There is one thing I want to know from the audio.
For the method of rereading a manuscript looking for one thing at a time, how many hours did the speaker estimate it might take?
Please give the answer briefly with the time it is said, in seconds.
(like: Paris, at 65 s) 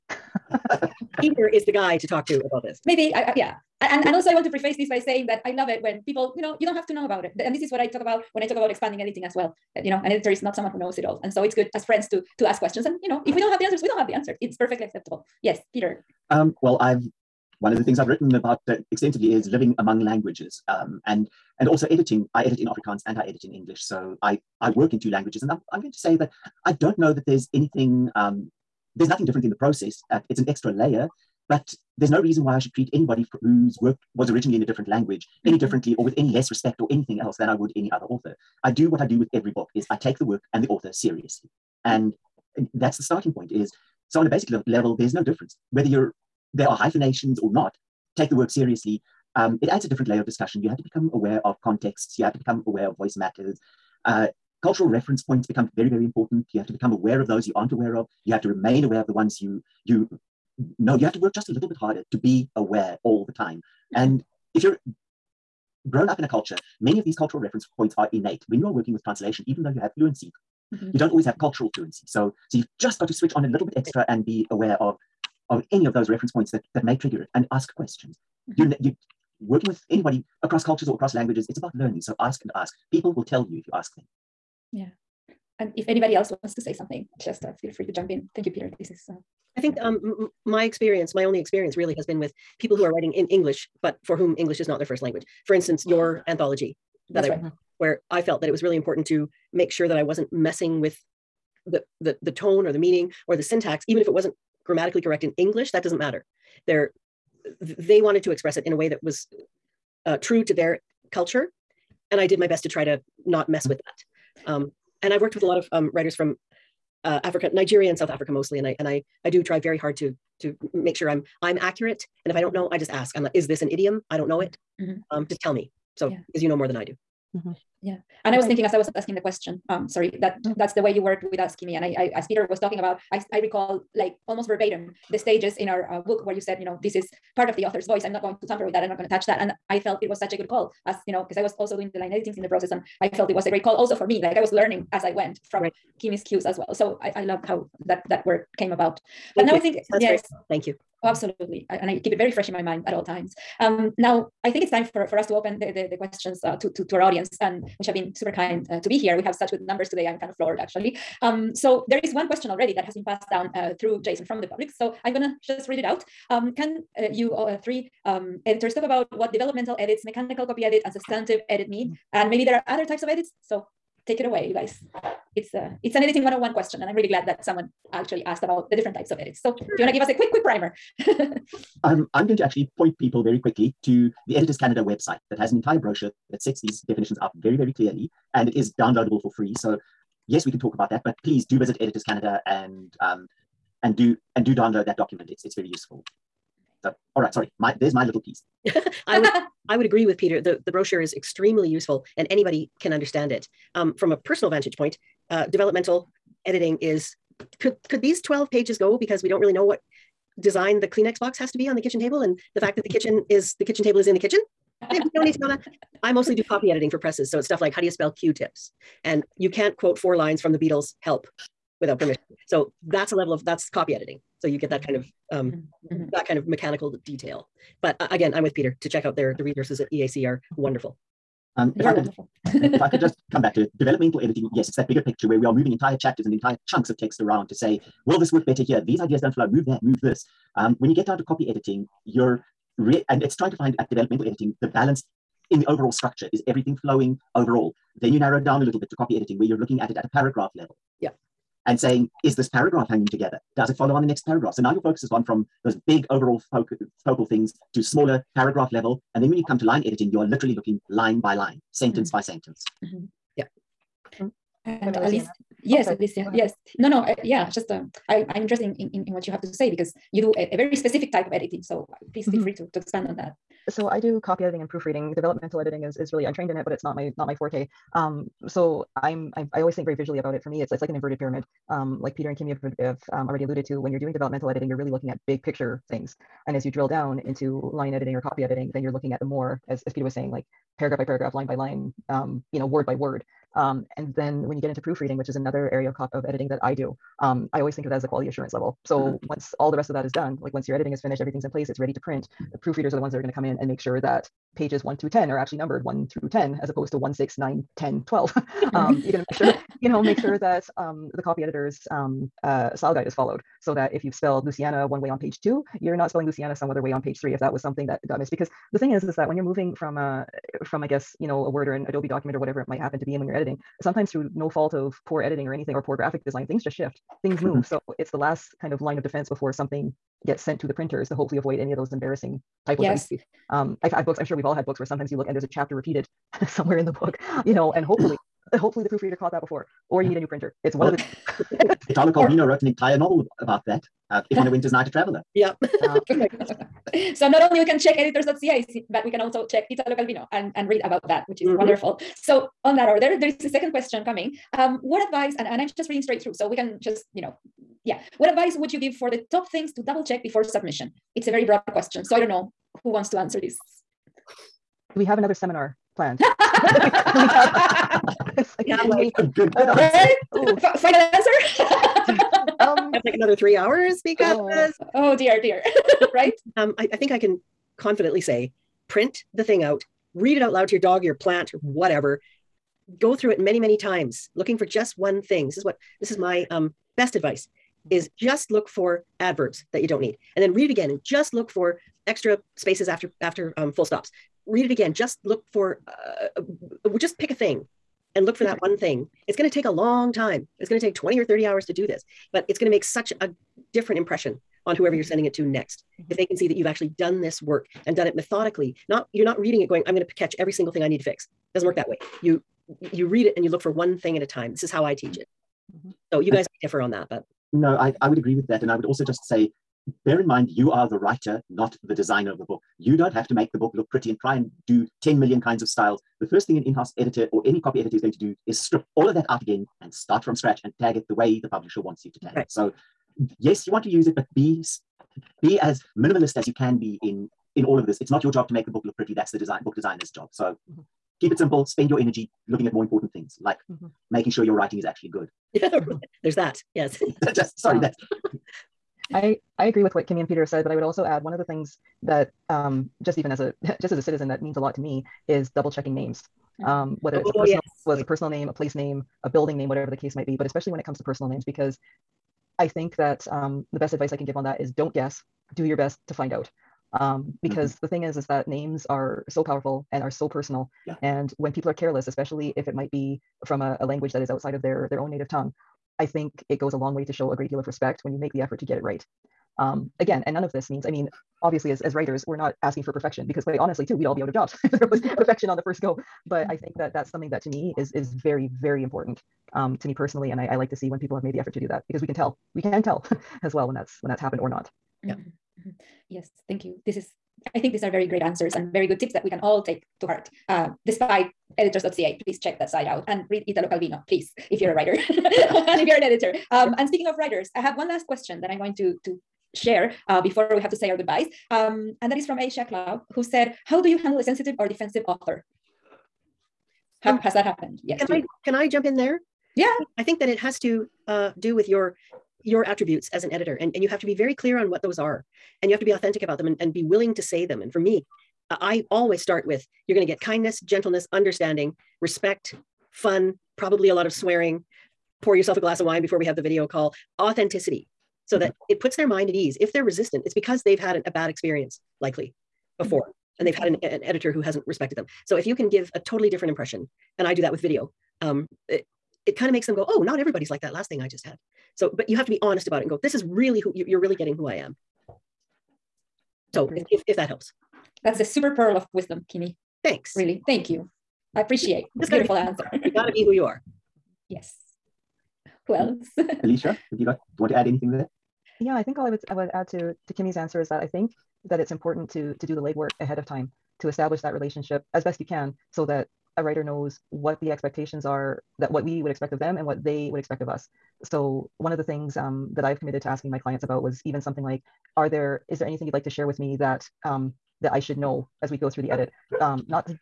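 20 or 30 hours, at 400 s.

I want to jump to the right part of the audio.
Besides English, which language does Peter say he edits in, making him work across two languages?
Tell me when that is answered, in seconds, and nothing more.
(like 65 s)
22 s.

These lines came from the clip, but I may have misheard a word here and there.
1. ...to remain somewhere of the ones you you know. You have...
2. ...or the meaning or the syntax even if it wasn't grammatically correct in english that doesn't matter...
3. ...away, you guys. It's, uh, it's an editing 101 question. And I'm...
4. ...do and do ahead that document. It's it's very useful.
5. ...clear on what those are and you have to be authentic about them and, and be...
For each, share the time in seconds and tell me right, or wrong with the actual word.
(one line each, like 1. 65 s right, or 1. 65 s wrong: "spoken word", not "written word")
1. 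58 s wrong: "aware", not "somewhere"
2. 102 s right
3. 174 s right
4. 193 s wrong: "download", not "ahead"
5. 524 s right.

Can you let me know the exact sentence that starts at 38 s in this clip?
I do what I do with every book is I take the work and the author seriously.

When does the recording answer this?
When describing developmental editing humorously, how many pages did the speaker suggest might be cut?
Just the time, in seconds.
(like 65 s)
208 s.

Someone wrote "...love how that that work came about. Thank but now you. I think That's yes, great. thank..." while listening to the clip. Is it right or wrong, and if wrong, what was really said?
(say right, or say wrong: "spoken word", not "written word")
right.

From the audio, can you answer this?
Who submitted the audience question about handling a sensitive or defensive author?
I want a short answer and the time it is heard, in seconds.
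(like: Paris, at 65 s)
Aisha Cloud, at 512 s.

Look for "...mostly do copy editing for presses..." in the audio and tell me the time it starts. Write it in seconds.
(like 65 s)
216 s.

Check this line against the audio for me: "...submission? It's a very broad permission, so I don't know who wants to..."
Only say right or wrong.
wrong.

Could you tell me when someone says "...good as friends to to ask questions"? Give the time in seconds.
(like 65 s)
11 s.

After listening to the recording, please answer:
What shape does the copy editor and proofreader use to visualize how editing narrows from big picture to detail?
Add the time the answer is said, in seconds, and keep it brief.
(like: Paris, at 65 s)
An inverted pyramid, at 280 s.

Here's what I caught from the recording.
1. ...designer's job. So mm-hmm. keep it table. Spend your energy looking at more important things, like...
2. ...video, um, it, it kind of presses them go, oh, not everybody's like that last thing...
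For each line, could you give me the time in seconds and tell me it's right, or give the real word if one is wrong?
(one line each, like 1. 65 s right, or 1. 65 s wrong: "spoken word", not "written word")
1. 439 s wrong: "simple", not "table"
2. 547 s wrong: "makes", not "presses".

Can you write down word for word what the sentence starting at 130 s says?
that's the way you worked with asking me.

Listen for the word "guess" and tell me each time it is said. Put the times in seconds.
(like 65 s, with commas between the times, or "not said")
320 s, 464 s.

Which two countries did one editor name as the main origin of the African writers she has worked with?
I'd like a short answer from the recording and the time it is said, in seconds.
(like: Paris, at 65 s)
Nigeria and South Africa, at 117 s.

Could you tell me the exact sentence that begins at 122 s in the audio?
And if I don't know, I just ask.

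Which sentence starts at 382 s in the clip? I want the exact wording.
Go through it many, many times, looking for just one thing.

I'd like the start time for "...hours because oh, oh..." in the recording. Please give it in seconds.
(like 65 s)
373 s.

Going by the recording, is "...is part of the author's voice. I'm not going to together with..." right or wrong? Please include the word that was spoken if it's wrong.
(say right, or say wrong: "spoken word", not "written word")
wrong: "tamper", not "together".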